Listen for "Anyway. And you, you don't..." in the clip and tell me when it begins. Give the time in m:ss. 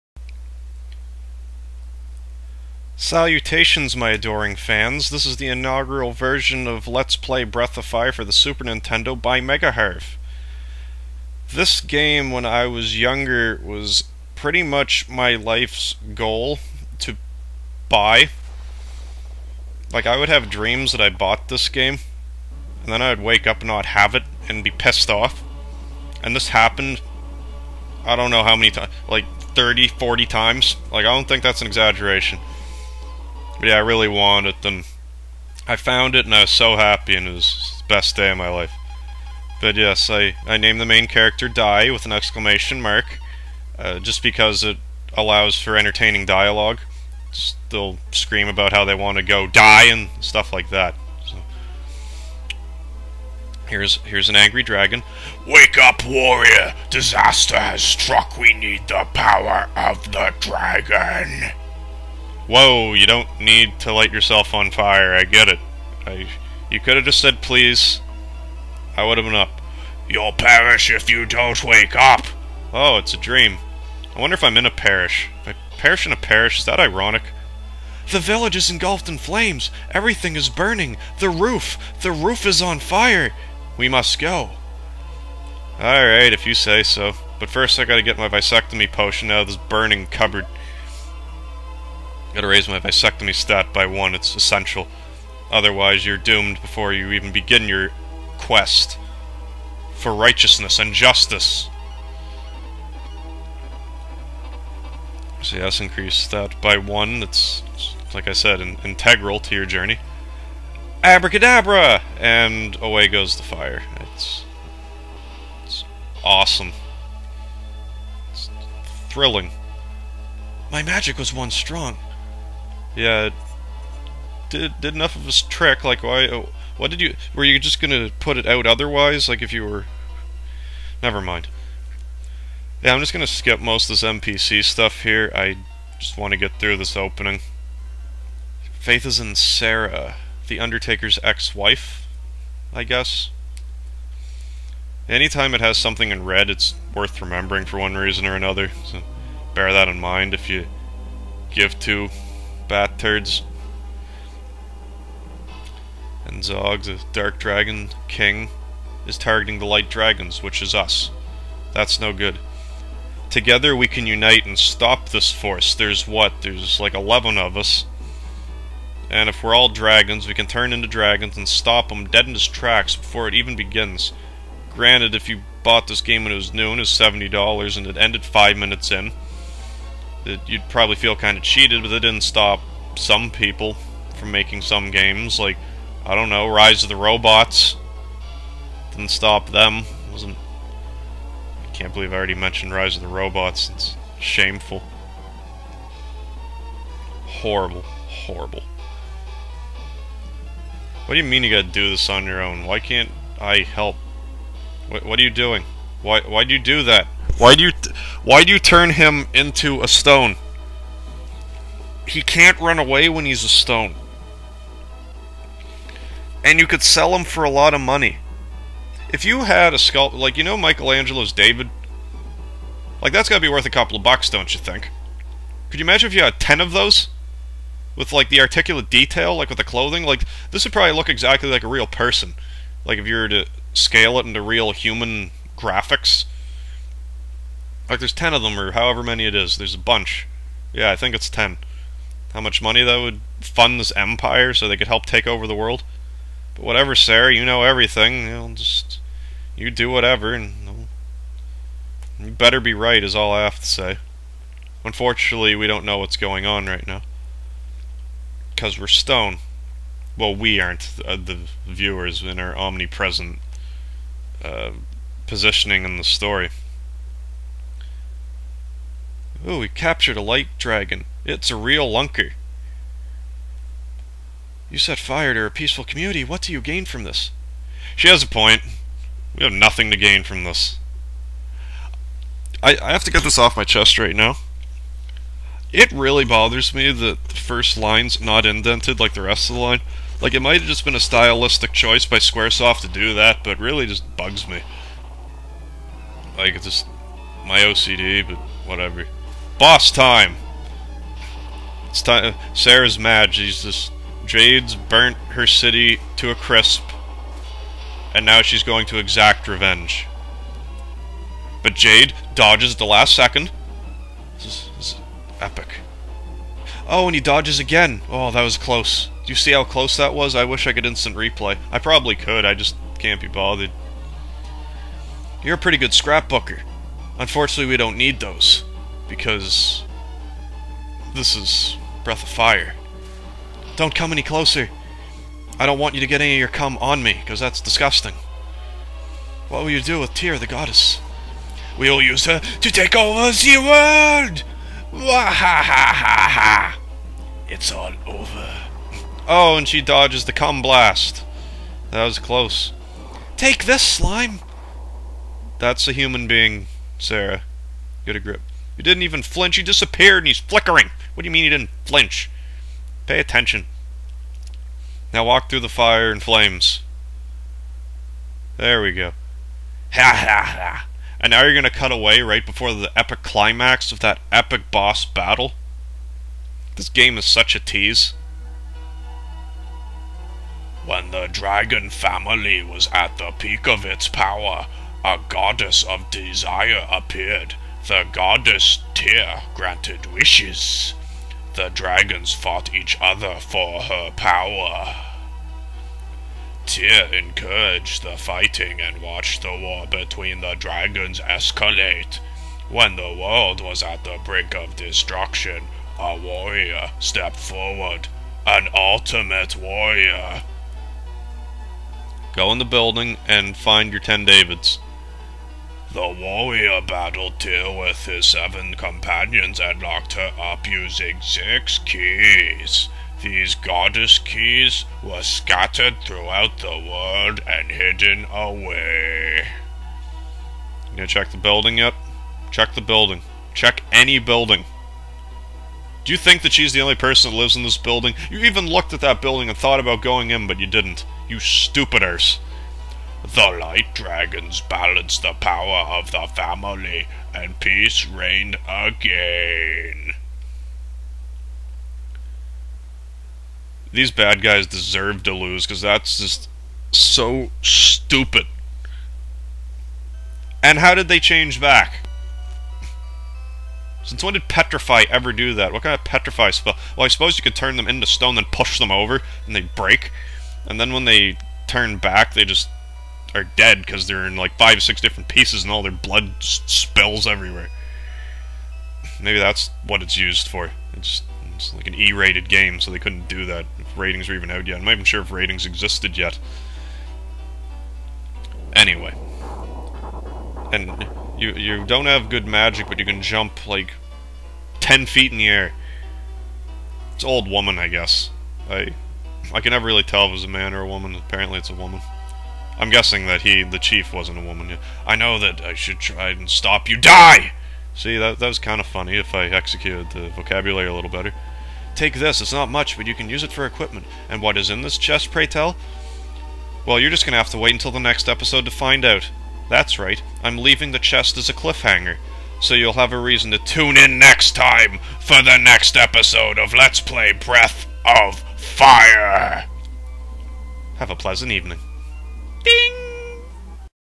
8:08.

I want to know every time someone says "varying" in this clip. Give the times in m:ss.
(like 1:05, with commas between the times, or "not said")
not said.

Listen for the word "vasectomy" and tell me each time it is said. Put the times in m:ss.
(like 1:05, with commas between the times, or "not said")
1:32.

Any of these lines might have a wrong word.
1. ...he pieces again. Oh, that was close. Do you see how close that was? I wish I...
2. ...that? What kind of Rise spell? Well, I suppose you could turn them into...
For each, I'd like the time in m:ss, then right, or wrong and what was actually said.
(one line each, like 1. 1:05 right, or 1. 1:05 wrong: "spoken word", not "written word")
1. 5:17 wrong: "dodges", not "pieces"
2. 7:45 wrong: "Petrify", not "Rise".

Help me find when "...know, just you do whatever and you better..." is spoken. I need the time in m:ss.
4:08.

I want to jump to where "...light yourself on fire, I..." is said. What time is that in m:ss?
1:03.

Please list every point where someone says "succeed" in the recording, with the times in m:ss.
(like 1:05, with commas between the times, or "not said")
not said.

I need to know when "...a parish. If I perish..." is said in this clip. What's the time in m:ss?
1:14.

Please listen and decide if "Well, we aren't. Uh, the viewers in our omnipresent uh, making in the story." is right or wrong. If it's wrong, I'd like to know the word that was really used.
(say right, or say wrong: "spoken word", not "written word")
wrong: "positioning", not "making".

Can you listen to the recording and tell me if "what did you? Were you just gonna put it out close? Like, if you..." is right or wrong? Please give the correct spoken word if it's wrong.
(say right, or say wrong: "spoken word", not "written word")
wrong: "otherwise", not "close".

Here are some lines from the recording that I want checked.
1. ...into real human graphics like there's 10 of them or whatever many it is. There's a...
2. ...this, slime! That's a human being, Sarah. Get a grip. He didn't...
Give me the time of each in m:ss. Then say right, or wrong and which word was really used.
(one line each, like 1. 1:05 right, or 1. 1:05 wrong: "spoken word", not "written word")
1. 3:54 wrong: "however", not "whatever"
2. 5:53 right.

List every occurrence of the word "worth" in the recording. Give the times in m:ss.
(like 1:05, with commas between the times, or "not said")
2:26, 3:43.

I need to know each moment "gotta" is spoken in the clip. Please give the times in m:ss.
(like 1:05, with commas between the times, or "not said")
1:27, 1:32, 3:21, 3:43.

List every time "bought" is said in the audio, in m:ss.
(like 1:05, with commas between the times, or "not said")
0:21, 2:55.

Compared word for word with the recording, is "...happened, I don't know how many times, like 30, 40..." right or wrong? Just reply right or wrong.
right.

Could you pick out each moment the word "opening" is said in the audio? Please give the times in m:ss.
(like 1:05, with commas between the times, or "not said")
2:16.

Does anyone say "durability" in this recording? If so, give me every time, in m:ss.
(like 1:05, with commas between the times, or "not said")
not said.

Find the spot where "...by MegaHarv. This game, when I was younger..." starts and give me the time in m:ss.
0:09.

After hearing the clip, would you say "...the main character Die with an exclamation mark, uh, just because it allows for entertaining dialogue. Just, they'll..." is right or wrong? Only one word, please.
right.